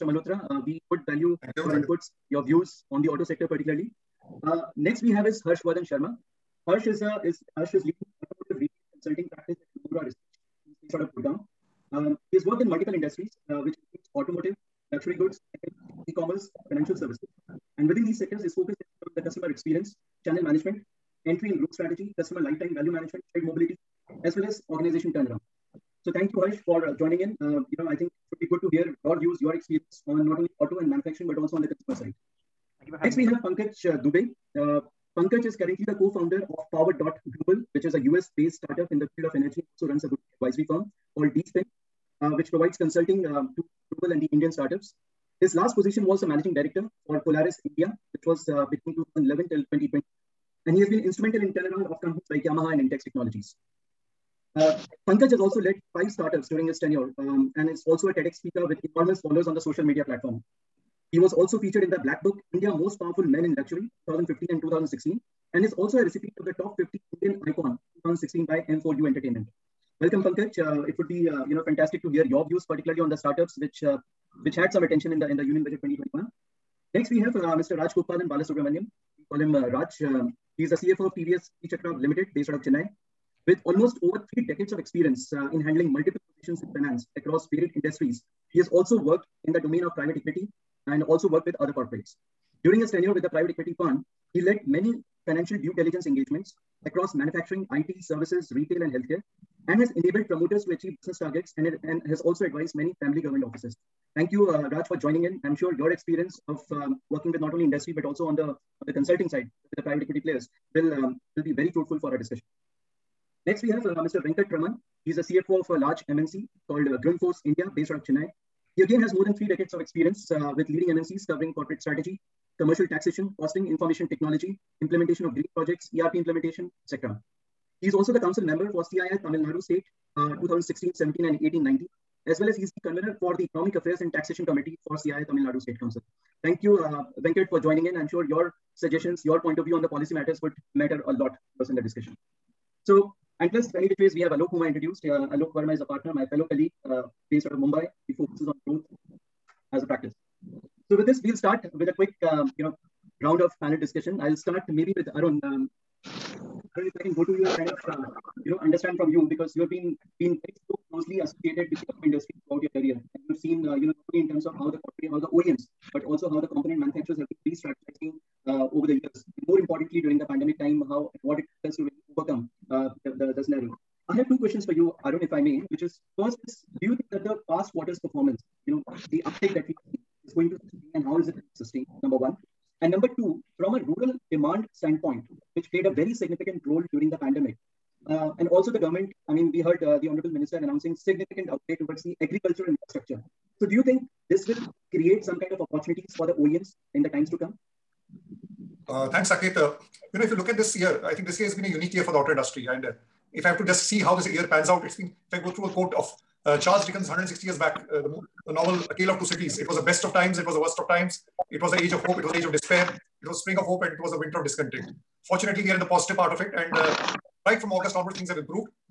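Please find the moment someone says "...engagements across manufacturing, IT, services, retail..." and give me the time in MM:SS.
01:36.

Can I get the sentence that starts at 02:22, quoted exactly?
So, and plus, many which ways we have Alok, whom I introduced.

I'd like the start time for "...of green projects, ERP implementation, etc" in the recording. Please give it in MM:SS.
02:05.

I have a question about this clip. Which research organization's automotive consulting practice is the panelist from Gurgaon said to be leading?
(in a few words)
Nomura Research.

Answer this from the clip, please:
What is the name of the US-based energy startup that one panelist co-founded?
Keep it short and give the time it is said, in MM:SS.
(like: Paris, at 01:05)
Power.Global, at 00:36.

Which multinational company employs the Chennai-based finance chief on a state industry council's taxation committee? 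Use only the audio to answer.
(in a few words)
Grundfos India.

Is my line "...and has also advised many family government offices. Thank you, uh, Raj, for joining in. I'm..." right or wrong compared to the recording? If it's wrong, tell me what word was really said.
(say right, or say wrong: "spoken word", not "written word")
right.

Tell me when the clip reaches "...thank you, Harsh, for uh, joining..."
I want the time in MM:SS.
00:26.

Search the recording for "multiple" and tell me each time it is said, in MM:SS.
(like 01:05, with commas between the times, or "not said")
00:12, 01:25.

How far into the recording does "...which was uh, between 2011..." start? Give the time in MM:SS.
00:48.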